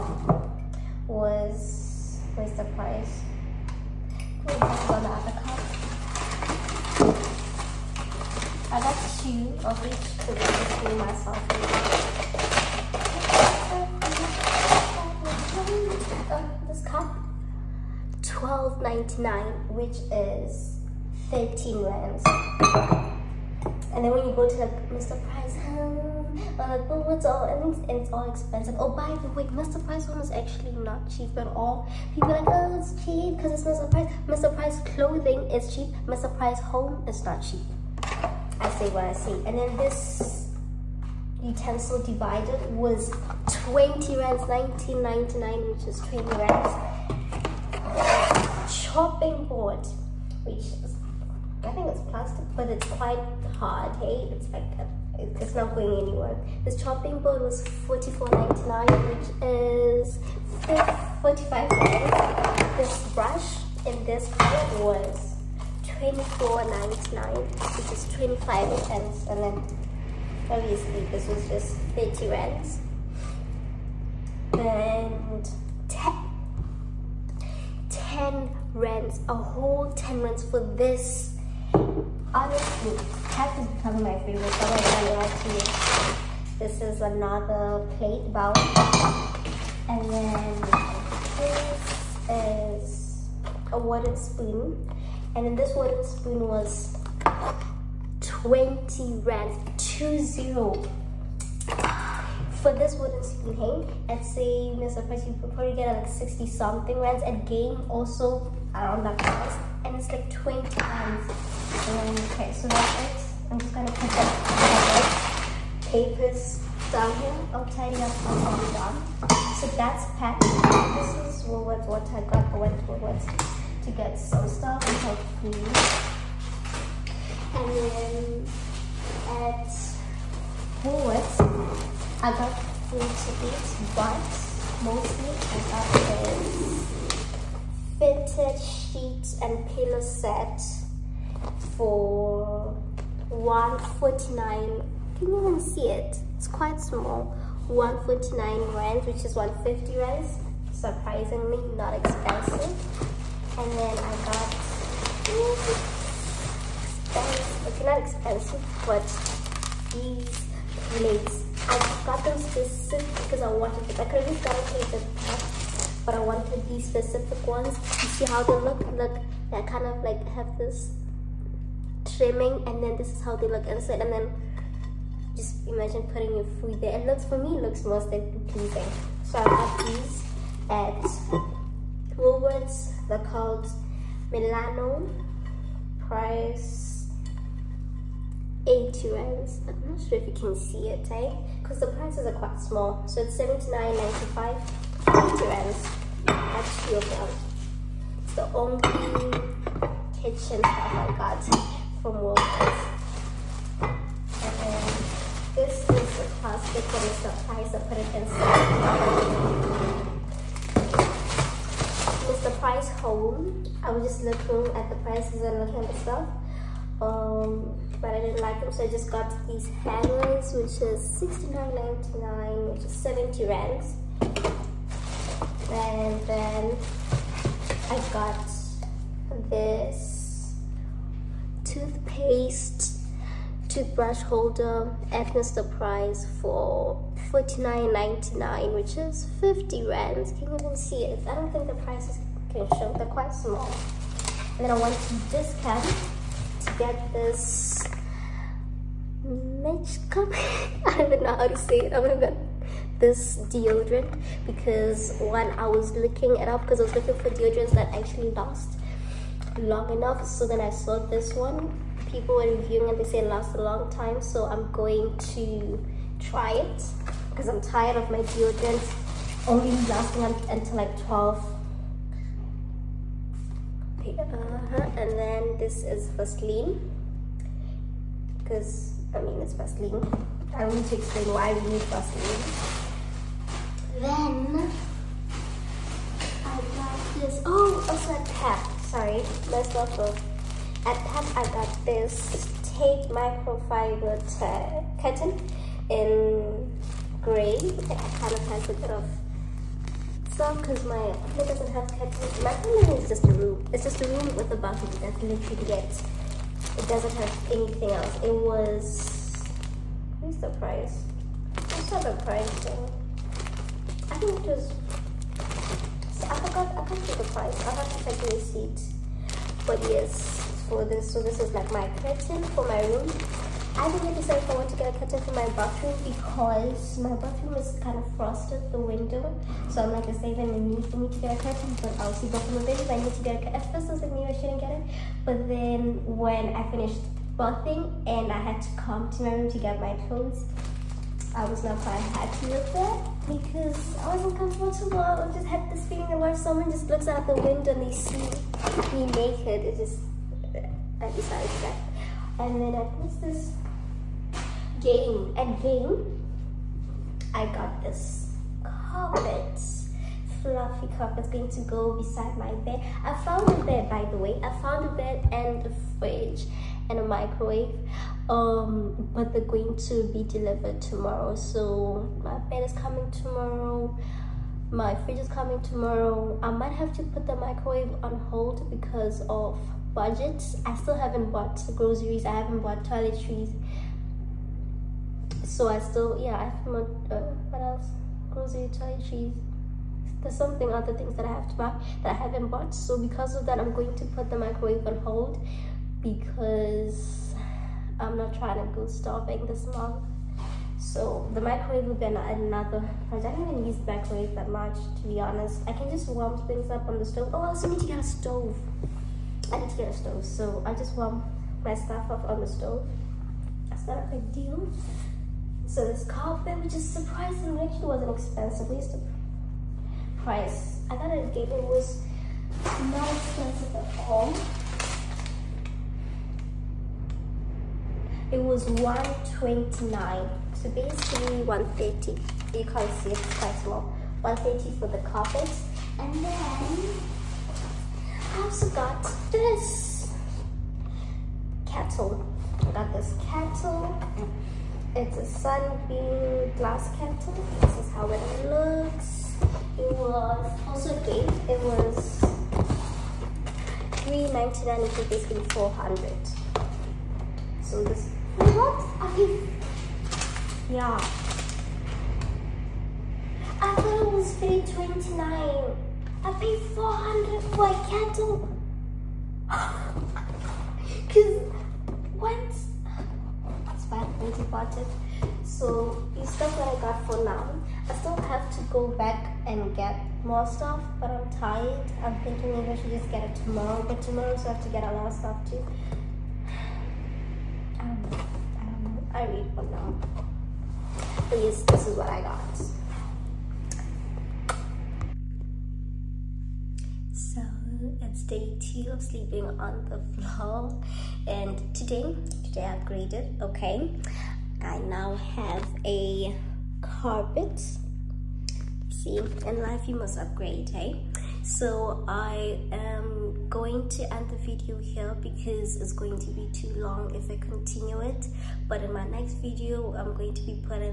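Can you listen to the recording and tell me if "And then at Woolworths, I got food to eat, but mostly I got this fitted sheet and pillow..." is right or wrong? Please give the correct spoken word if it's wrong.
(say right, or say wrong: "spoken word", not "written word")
right.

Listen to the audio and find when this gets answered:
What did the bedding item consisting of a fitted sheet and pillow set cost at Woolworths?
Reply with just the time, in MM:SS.
02:27.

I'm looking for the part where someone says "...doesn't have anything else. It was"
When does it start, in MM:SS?
05:06.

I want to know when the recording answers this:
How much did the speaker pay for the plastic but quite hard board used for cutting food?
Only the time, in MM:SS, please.
00:57.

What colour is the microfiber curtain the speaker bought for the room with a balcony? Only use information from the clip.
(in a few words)
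Gray.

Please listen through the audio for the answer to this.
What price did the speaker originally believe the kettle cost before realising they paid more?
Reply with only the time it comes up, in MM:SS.
07:44.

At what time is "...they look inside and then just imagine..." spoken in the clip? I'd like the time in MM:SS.
02:53.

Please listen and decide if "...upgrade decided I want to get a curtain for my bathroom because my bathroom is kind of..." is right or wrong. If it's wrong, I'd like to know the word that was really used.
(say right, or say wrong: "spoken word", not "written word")
wrong: "decide", not "upgrade".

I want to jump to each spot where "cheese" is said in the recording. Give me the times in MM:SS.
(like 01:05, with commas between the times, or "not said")
06:29.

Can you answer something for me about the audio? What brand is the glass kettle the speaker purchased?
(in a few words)
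Sunbeam.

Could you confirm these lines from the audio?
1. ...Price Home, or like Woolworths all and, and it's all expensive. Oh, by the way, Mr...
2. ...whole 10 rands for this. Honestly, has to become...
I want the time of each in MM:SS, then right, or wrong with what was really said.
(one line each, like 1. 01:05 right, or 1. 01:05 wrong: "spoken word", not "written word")
1. 00:25 right
2. 01:19 right.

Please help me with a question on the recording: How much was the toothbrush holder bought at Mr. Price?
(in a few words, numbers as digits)
R49.99.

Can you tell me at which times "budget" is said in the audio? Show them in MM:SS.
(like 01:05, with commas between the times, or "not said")
06:19, 07:54.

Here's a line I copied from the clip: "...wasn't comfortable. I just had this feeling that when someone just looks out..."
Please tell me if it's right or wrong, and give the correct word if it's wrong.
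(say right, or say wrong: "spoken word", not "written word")
right.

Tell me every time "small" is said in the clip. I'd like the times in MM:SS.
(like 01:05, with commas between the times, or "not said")
02:26, 03:12, 04:03, 07:13.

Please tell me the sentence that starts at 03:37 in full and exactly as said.
Um, but I didn't like them, so I just got these handles, which is sixty nine ninety nine, which is 70 rands.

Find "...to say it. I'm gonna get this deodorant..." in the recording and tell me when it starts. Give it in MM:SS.
04:11.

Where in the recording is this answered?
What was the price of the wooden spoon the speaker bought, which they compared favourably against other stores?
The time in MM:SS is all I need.
01:38.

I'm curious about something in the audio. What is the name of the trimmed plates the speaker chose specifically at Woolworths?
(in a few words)
Milano.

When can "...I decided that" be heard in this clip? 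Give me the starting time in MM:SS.
05:50.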